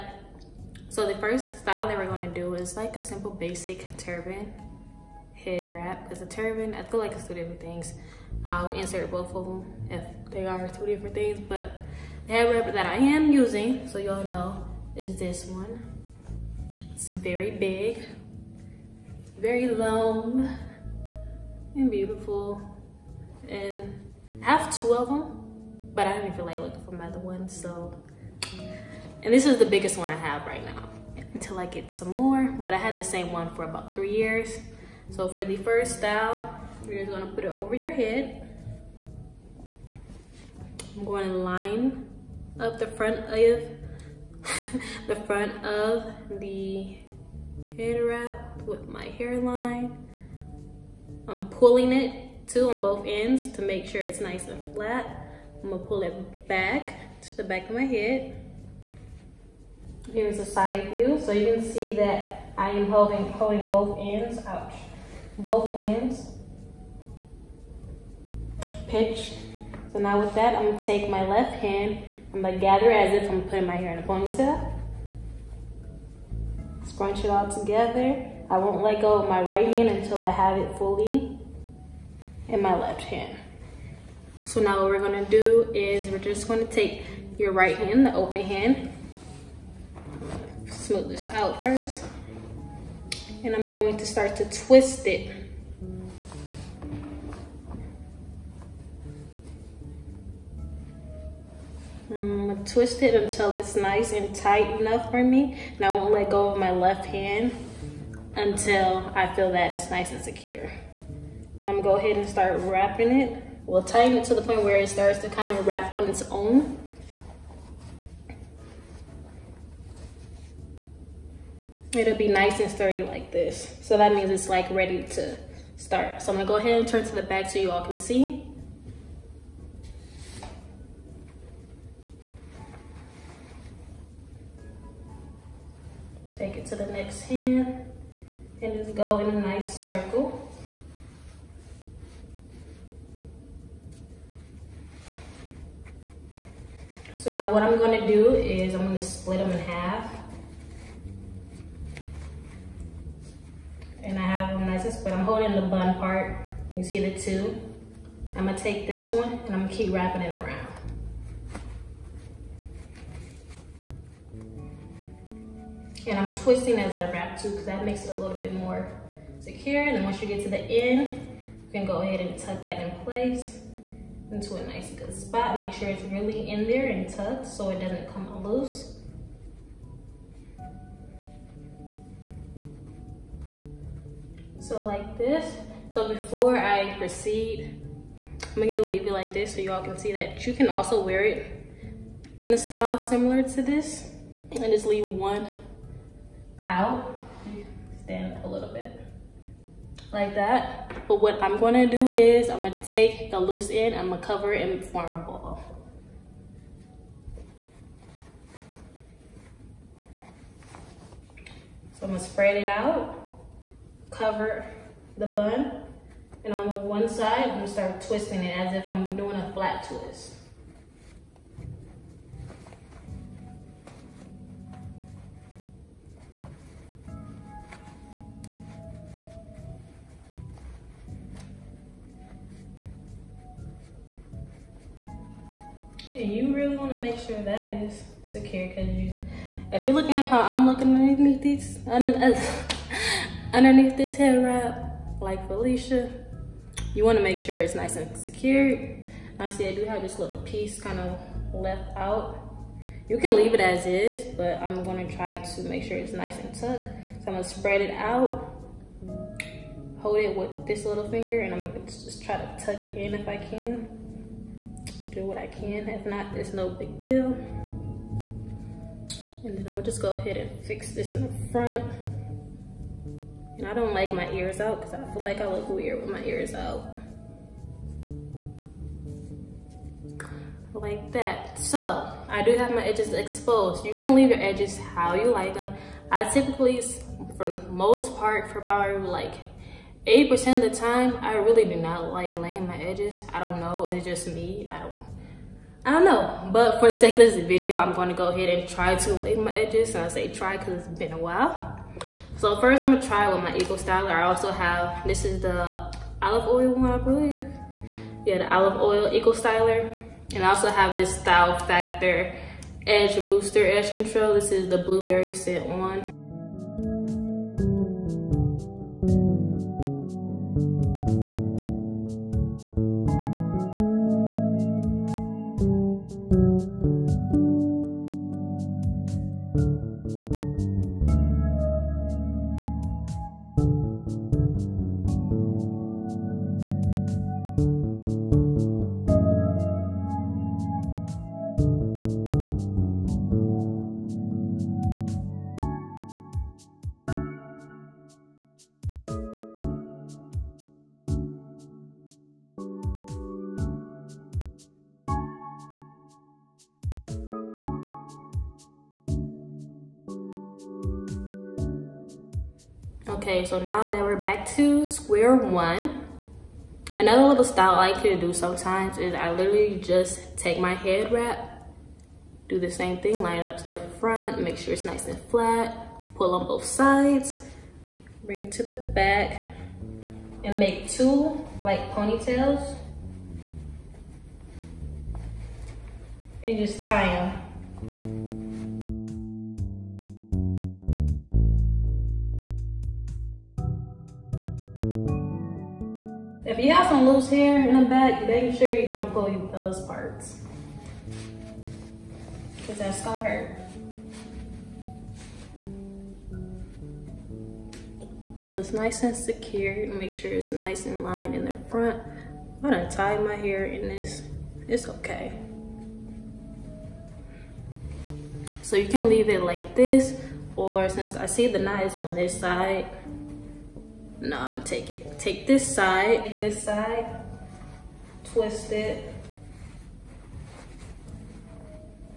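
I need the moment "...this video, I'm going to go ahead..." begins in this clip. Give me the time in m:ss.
4:57.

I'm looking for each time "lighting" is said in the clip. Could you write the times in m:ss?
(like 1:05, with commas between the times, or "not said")
not said.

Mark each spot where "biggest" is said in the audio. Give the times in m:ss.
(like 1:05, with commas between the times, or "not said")
0:29.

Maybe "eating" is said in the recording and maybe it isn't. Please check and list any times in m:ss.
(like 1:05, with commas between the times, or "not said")
not said.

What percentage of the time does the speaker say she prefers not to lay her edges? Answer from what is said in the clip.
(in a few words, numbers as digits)
80%.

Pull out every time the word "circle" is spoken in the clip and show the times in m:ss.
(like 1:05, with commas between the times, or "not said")
2:19.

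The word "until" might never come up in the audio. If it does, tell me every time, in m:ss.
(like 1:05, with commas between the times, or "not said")
0:31, 1:19, 1:43, 1:48.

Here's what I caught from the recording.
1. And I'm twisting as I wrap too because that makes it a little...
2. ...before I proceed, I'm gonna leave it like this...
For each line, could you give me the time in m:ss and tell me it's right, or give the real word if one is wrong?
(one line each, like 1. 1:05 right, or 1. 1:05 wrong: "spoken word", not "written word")
1. 2:46 right
2. 3:06 right.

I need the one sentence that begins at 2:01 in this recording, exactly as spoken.
it'll be nice and sturdy like this.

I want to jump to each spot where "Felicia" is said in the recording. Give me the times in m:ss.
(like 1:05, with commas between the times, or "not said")
4:05.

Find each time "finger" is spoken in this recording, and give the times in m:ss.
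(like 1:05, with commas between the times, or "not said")
4:21.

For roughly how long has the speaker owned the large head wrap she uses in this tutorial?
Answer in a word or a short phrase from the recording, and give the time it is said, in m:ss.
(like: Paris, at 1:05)
3 years, at 0:33.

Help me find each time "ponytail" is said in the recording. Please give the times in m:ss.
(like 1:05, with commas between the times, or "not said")
1:14, 6:21.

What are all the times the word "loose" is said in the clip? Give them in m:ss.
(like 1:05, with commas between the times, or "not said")
2:58, 3:23, 6:37.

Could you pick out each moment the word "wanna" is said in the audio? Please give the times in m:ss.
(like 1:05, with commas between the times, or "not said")
3:56, 4:07.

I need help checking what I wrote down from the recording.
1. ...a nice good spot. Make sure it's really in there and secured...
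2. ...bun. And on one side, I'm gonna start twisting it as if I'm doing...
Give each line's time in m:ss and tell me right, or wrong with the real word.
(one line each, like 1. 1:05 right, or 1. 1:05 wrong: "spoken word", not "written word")
1. 2:54 wrong: "tucked", not "secured"
2. 3:35 right.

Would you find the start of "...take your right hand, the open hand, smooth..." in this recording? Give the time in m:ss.
1:26.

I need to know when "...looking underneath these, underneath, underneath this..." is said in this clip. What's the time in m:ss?
4:00.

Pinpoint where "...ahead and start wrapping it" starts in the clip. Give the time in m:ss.
1:51.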